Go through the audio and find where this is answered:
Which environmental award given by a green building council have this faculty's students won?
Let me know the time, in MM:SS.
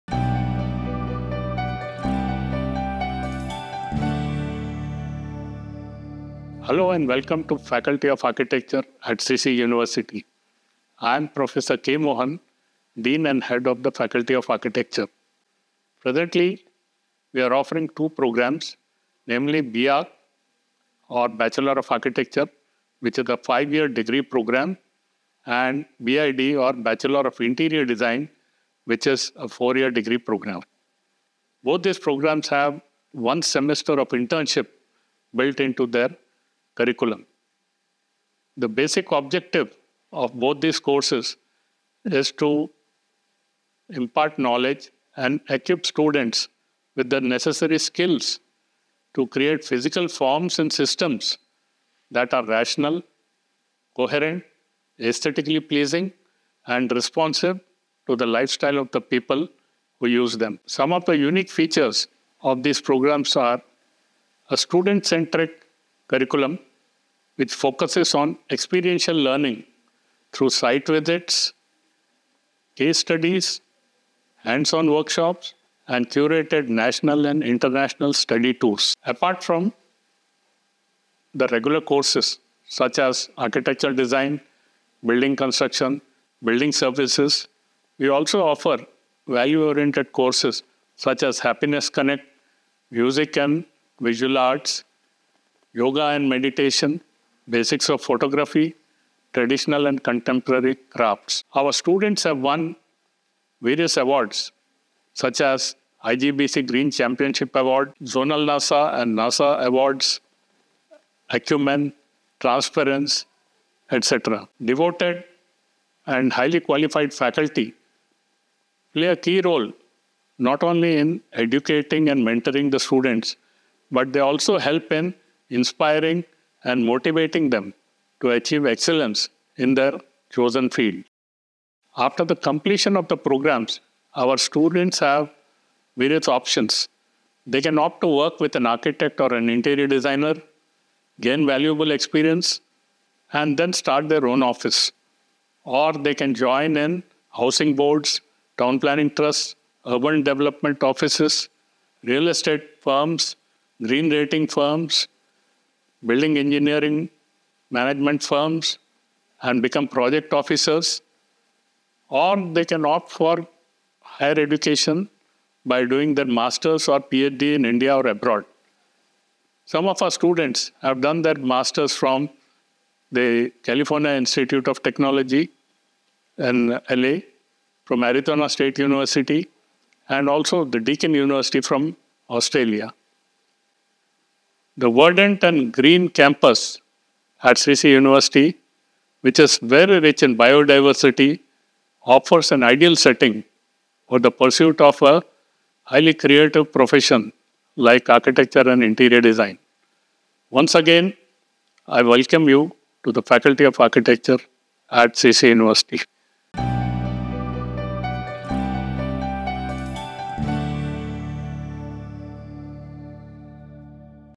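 01:46.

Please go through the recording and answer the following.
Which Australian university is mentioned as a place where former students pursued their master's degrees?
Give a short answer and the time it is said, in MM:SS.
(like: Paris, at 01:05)
Deakin University, at 03:00.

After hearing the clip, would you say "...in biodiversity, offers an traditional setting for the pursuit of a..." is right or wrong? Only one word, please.
wrong.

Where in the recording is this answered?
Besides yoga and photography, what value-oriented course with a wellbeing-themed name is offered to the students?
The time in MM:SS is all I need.
01:31.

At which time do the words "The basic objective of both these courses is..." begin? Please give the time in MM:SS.
00:38.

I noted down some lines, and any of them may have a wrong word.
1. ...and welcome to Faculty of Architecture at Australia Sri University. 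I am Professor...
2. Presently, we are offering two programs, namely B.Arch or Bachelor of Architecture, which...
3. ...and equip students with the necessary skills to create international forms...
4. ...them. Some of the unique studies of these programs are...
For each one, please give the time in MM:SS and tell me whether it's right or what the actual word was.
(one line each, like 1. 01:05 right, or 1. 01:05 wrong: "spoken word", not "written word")
1. 00:06 wrong: "Sri", not "Australia"
2. 00:15 right
3. 00:45 wrong: "physical", not "international"
4. 01:00 wrong: "features", not "studies".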